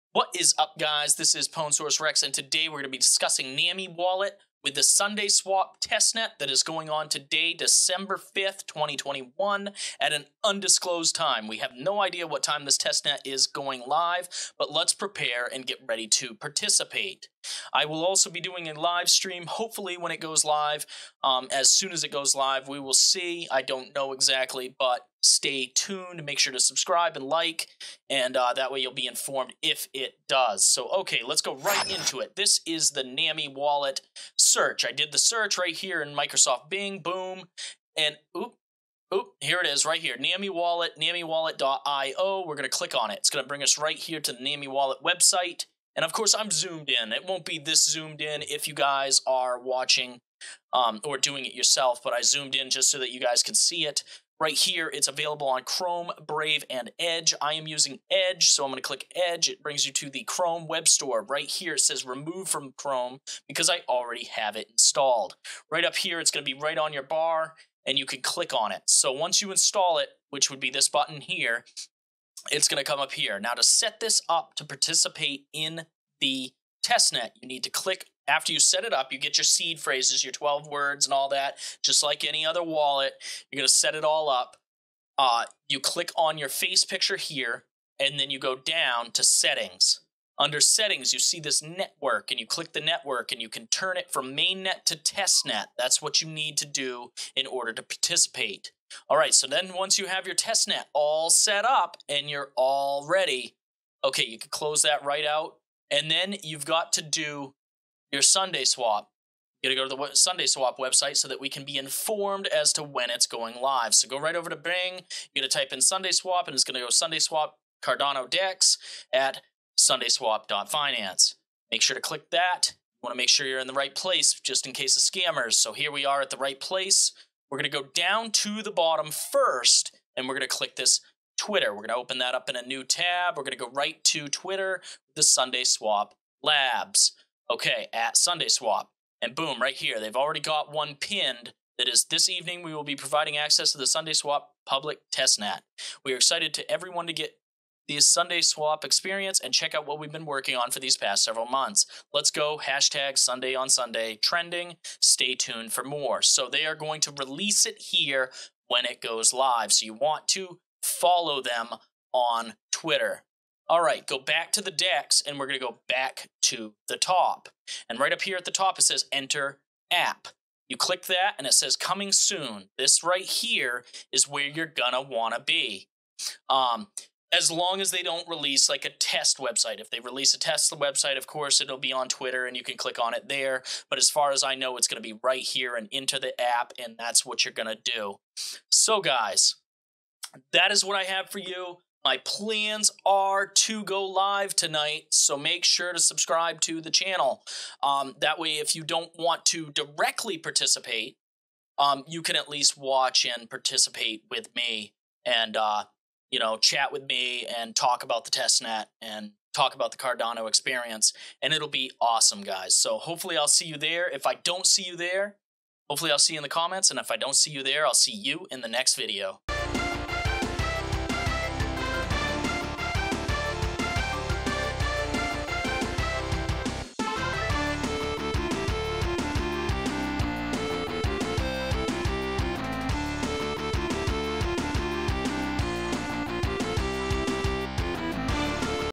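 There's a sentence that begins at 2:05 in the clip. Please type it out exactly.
So here we are at the right place.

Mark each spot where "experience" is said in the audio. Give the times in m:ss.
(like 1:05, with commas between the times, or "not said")
2:28, 3:30.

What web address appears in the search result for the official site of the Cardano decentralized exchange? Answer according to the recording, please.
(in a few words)
SundaeSwap.finance.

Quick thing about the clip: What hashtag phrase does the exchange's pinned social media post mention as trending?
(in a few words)
Sundae on Sunday.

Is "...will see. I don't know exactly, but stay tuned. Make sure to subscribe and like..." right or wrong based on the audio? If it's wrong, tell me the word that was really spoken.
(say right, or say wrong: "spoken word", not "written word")
right.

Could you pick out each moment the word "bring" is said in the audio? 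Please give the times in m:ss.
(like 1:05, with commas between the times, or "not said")
0:43, 0:59.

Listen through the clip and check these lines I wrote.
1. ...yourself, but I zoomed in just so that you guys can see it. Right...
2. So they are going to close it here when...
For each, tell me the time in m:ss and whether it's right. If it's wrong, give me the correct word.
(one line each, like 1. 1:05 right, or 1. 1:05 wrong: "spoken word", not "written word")
1. 0:51 right
2. 2:36 wrong: "release", not "close".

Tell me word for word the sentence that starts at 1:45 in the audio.
And then you've got to do your SundaeSwap.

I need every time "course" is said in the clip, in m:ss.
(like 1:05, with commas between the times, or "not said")
0:46, 3:01.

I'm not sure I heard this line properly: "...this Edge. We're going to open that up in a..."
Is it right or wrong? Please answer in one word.
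wrong.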